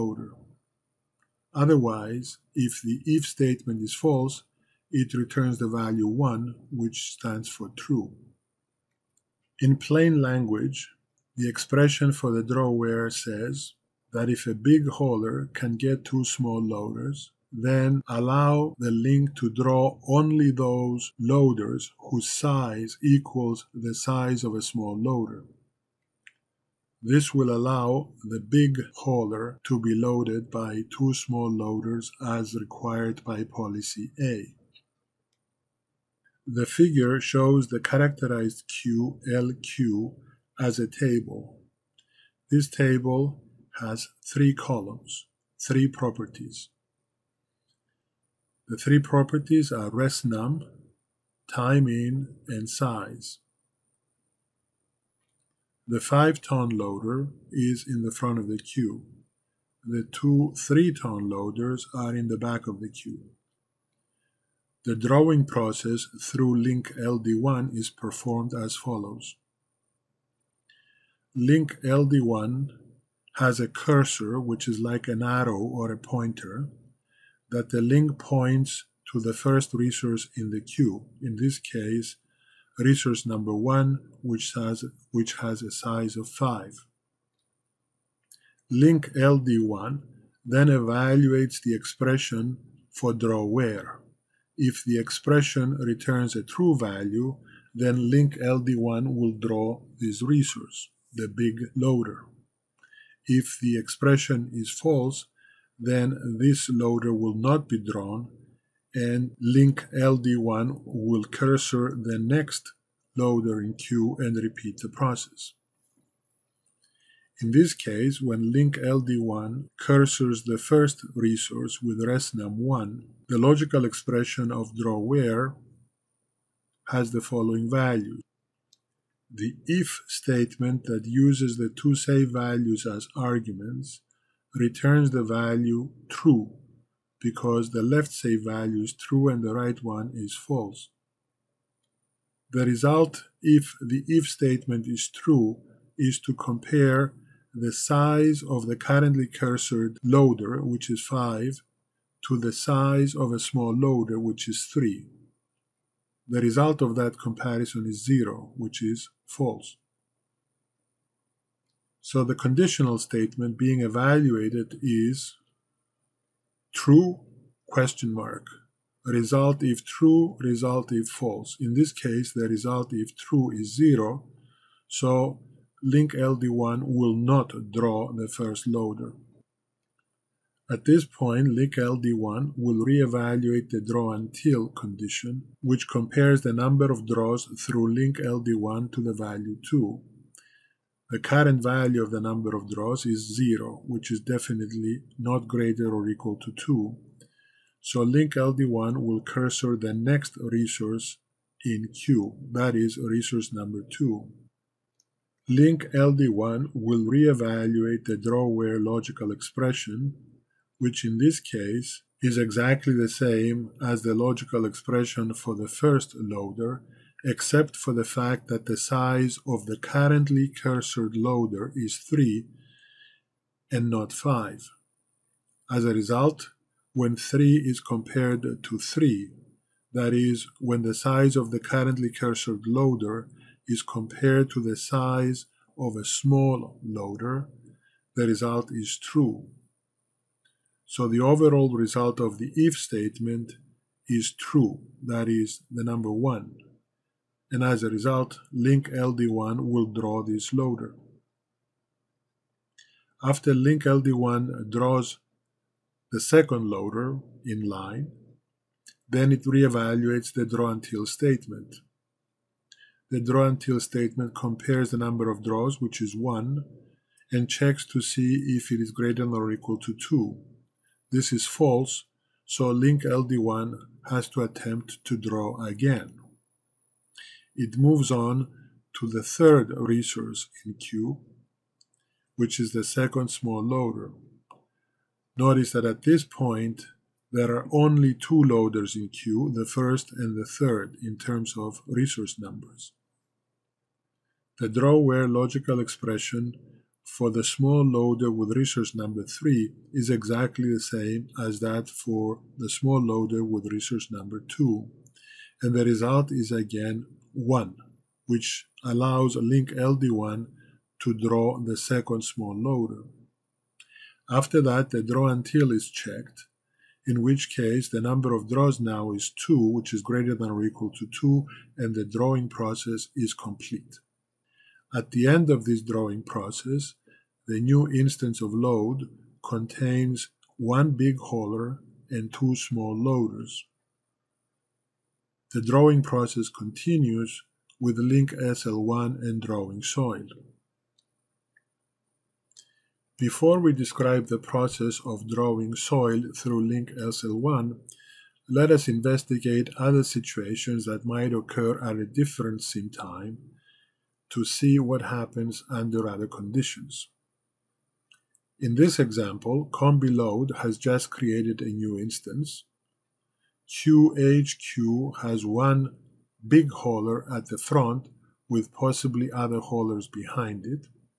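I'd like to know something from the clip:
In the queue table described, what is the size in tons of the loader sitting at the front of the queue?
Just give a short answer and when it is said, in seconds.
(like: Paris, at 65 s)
5, at 55 s.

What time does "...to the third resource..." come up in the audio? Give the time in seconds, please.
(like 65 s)
278 s.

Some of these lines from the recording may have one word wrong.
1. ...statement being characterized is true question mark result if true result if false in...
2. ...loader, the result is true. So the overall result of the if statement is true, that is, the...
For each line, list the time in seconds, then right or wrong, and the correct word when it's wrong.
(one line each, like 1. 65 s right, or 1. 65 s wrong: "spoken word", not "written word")
1. 162 s wrong: "evaluated", not "characterized"
2. 236 s right.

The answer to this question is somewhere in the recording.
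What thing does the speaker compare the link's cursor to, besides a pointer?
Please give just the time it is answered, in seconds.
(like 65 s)
75 s.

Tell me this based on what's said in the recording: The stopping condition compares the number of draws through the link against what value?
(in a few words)
2.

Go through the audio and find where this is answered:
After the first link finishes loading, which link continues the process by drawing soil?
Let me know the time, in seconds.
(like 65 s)
337 s.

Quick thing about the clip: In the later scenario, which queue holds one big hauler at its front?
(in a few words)
QHQ.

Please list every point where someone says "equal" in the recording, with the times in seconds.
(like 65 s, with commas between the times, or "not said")
23 s, 196 s, 269 s, 320 s.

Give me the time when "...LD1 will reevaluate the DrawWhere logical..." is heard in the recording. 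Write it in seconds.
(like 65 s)
205 s.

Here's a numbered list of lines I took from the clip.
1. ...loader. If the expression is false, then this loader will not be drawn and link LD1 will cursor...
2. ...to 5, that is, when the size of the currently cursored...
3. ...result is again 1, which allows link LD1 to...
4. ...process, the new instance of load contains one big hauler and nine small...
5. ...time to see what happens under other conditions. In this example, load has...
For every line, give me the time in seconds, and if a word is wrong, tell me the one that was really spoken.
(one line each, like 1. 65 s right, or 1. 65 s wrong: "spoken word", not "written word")
1. 101 s right
2. 228 s wrong: "3", not "5"
3. 305 s right
4. 326 s wrong: "two", not "nine"
5. 352 s right.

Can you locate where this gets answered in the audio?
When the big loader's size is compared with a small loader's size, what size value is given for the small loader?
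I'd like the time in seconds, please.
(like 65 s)
154 s.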